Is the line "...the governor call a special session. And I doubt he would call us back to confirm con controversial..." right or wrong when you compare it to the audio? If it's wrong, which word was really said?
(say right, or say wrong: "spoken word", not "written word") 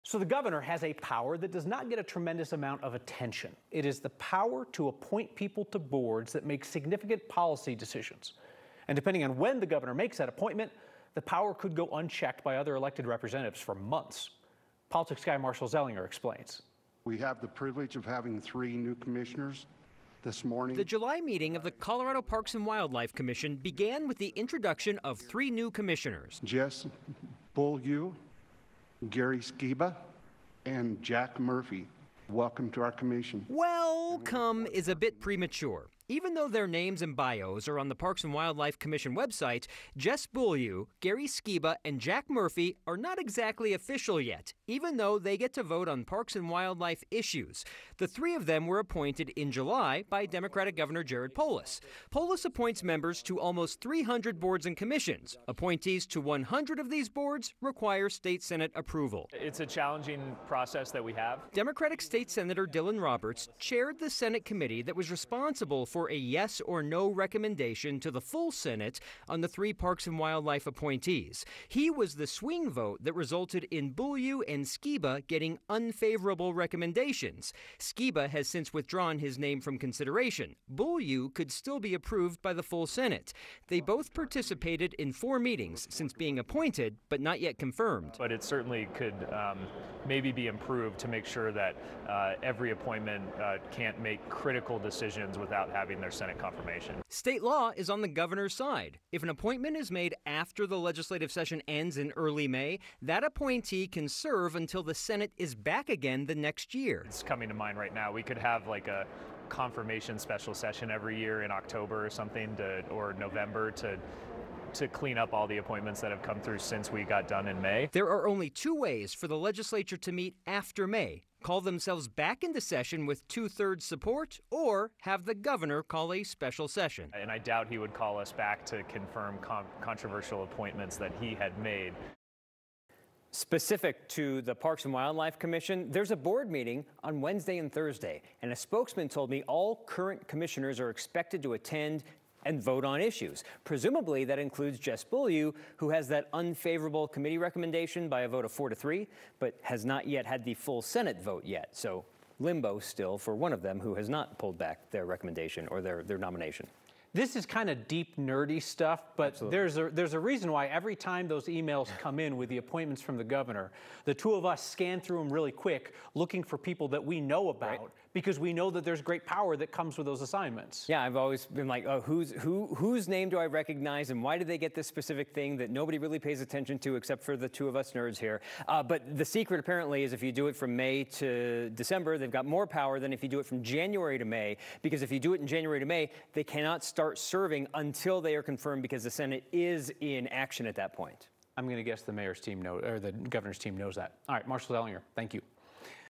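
right.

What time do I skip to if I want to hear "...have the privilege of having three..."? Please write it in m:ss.
0:17.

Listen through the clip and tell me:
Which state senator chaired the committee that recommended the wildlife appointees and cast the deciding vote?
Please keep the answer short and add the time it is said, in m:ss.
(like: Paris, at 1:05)
Dylan Roberts, at 1:02.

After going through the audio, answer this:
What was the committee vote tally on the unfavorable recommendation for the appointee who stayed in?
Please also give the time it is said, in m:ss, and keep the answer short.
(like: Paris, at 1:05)
4 to 3, at 2:28.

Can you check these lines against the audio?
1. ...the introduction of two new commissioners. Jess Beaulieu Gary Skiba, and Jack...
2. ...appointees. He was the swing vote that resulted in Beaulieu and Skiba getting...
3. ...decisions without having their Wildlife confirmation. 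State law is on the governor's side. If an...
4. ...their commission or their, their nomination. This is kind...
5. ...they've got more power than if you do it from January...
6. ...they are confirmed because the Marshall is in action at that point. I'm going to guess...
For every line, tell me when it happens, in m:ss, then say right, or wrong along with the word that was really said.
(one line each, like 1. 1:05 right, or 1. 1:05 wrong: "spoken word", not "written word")
1. 0:24 wrong: "three", not "two"
2. 1:10 right
3. 1:34 wrong: "Senate", not "Wildlife"
4. 2:34 wrong: "recommendation", not "commission"
5. 3:02 right
6. 3:08 wrong: "Senate", not "Marshall".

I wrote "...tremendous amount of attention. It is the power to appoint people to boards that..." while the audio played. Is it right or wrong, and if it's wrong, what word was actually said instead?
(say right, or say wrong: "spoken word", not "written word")
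right.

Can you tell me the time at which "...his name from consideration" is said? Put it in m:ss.
1:19.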